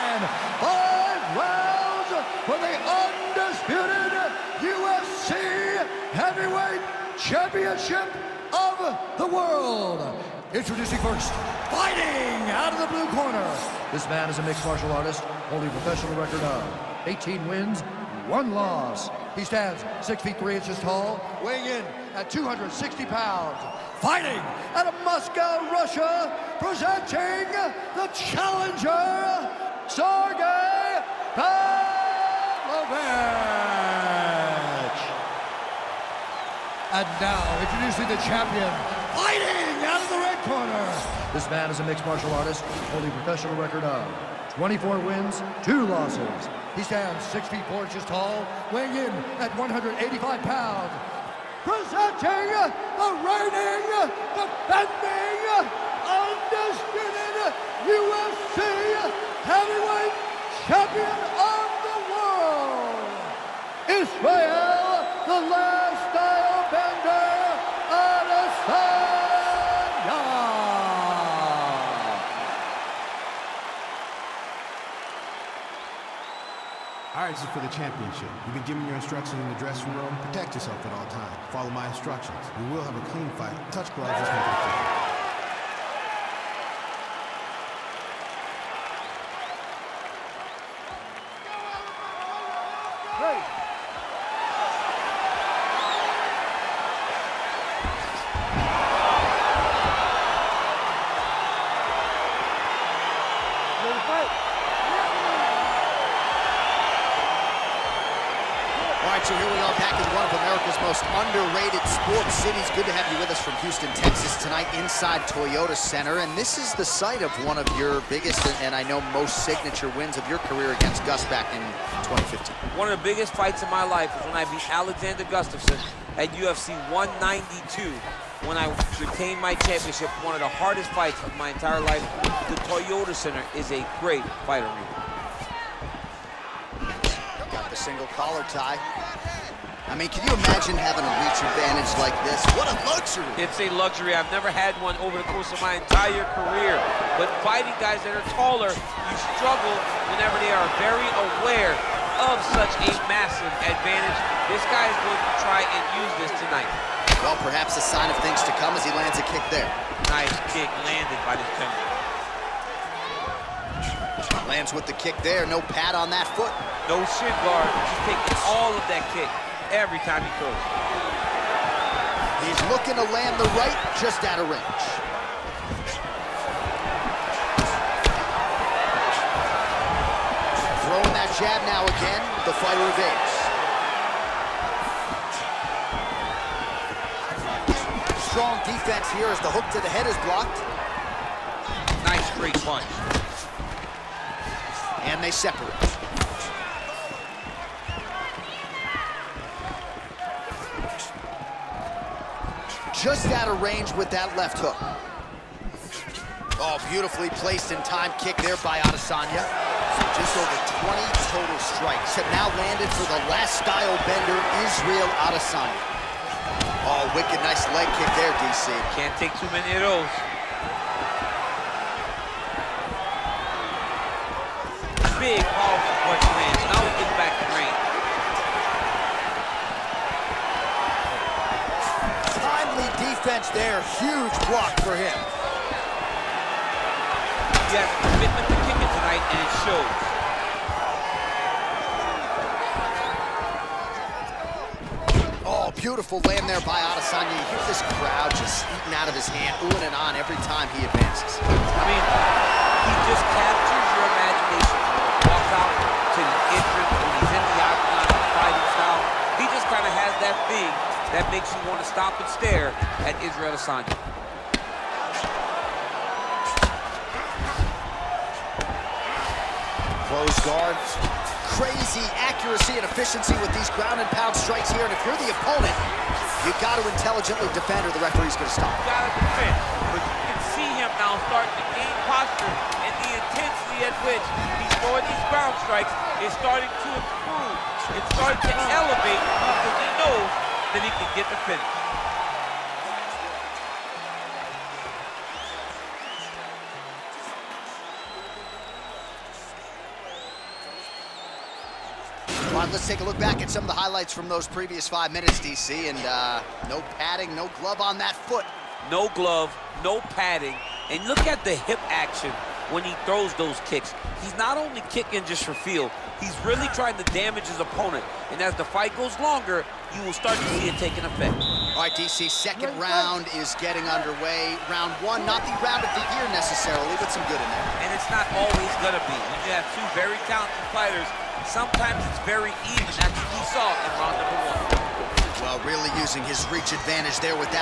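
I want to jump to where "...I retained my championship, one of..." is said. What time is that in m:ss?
2:08.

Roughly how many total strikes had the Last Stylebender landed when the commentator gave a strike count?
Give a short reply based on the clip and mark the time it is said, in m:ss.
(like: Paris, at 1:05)
Just over 20, at 3:30.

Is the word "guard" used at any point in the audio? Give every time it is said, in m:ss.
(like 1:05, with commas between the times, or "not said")
2:47, 4:30.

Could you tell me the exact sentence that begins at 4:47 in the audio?
It's starting to elevate because he knows he can get the finish.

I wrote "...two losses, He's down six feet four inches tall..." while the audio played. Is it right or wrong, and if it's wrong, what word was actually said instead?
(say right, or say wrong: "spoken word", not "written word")
right.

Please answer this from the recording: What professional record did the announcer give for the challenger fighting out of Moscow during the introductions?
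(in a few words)
18 wins, 1 loss.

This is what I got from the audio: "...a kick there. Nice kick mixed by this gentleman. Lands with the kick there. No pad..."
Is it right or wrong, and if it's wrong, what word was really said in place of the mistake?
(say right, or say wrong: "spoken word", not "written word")
wrong: "landed", not "mixed".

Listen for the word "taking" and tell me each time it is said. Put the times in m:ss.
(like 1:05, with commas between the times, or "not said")
2:48, 5:20.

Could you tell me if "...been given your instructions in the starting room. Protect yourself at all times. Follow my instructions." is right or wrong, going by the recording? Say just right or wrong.
wrong.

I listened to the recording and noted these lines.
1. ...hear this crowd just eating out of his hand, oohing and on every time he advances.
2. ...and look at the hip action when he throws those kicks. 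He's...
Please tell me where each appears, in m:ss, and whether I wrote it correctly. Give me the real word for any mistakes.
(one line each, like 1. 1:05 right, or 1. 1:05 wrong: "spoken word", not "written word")
1. 4:07 right
2. 5:10 right.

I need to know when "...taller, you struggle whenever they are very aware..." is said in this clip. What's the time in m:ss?
2:28.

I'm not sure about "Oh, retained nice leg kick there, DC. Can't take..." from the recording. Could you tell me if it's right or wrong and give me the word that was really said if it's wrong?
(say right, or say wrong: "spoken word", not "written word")
wrong: "wicked", not "retained".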